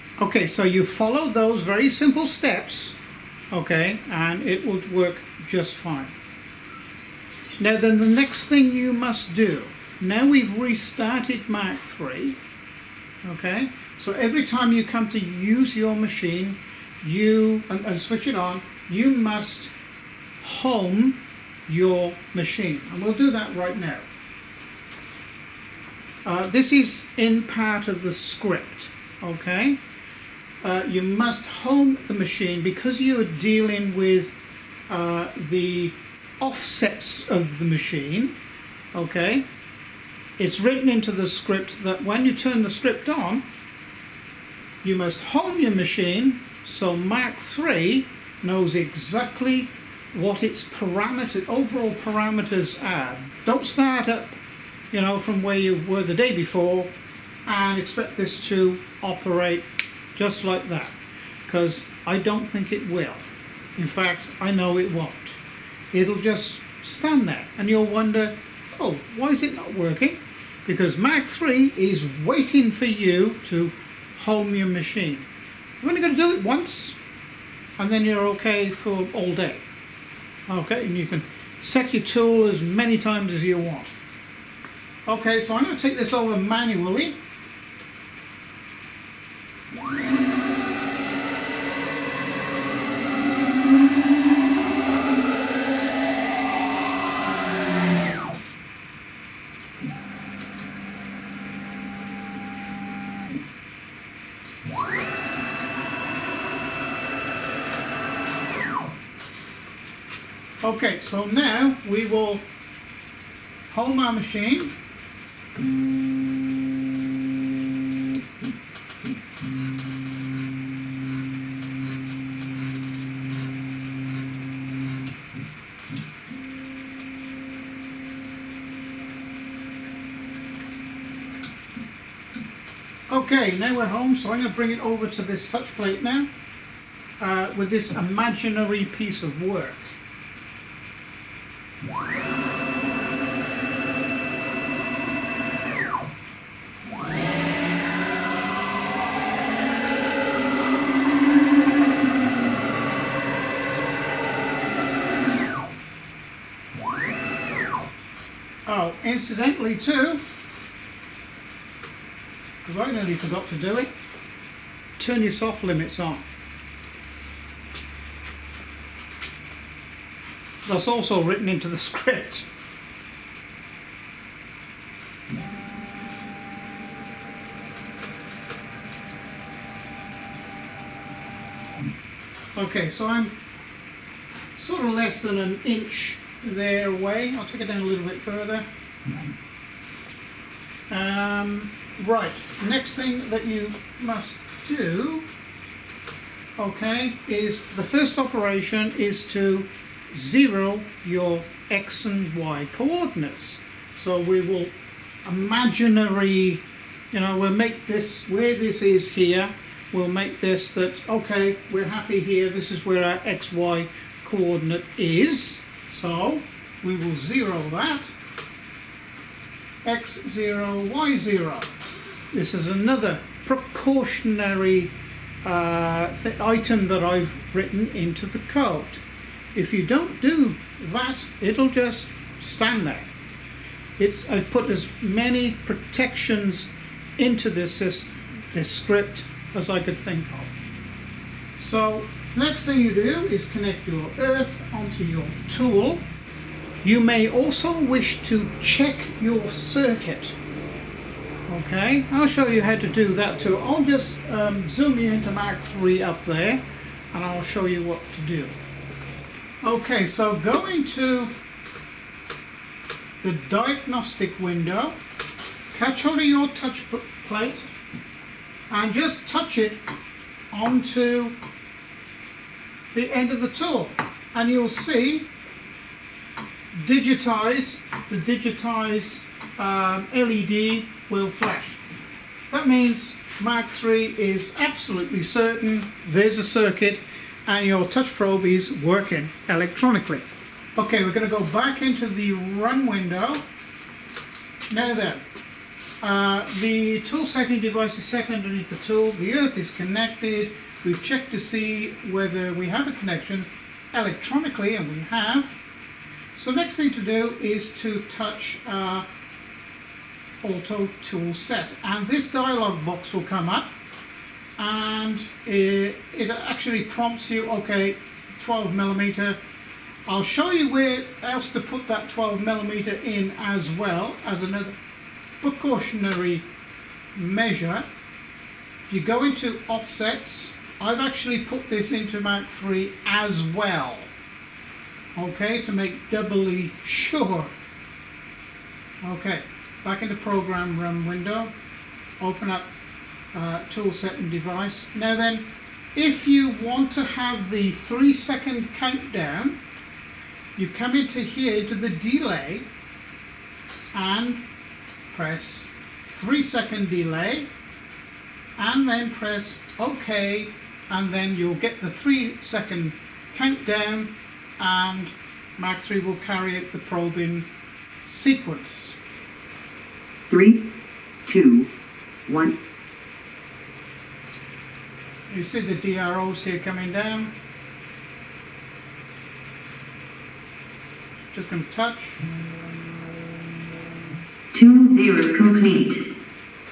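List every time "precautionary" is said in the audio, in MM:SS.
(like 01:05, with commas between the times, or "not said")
03:43, 05:25.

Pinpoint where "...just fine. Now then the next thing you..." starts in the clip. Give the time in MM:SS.
00:05.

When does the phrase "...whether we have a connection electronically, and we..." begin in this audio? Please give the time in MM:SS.
05:02.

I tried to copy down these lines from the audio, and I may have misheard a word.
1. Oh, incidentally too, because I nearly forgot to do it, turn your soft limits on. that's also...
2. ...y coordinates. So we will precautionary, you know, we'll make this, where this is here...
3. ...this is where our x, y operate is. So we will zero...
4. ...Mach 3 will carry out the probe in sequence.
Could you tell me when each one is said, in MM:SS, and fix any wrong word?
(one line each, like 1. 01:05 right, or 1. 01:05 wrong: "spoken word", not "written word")
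1. 02:38 right
2. 03:22 wrong: "imaginary", not "precautionary"
3. 03:32 wrong: "coordinate", not "operate"
4. 06:05 right.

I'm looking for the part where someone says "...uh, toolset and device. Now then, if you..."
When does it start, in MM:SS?
05:43.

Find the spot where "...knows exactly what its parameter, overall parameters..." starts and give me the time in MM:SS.
00:48.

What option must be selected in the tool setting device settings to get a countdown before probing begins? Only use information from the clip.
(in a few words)
three second delay.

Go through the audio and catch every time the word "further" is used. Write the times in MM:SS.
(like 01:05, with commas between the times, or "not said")
03:08.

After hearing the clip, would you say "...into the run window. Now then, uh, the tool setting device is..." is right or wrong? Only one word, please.
right.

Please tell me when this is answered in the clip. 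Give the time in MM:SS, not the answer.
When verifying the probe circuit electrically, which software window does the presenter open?
04:23.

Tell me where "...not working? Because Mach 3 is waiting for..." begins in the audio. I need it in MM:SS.
01:09.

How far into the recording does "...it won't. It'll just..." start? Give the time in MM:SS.
01:04.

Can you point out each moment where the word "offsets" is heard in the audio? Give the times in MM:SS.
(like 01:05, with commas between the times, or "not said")
00:36, 05:29.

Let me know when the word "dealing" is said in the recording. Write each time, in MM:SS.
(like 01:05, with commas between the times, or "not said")
00:33.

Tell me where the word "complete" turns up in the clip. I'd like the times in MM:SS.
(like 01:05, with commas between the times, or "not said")
06:25.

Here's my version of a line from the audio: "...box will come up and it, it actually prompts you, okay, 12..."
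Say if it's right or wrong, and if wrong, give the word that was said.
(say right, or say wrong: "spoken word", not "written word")
right.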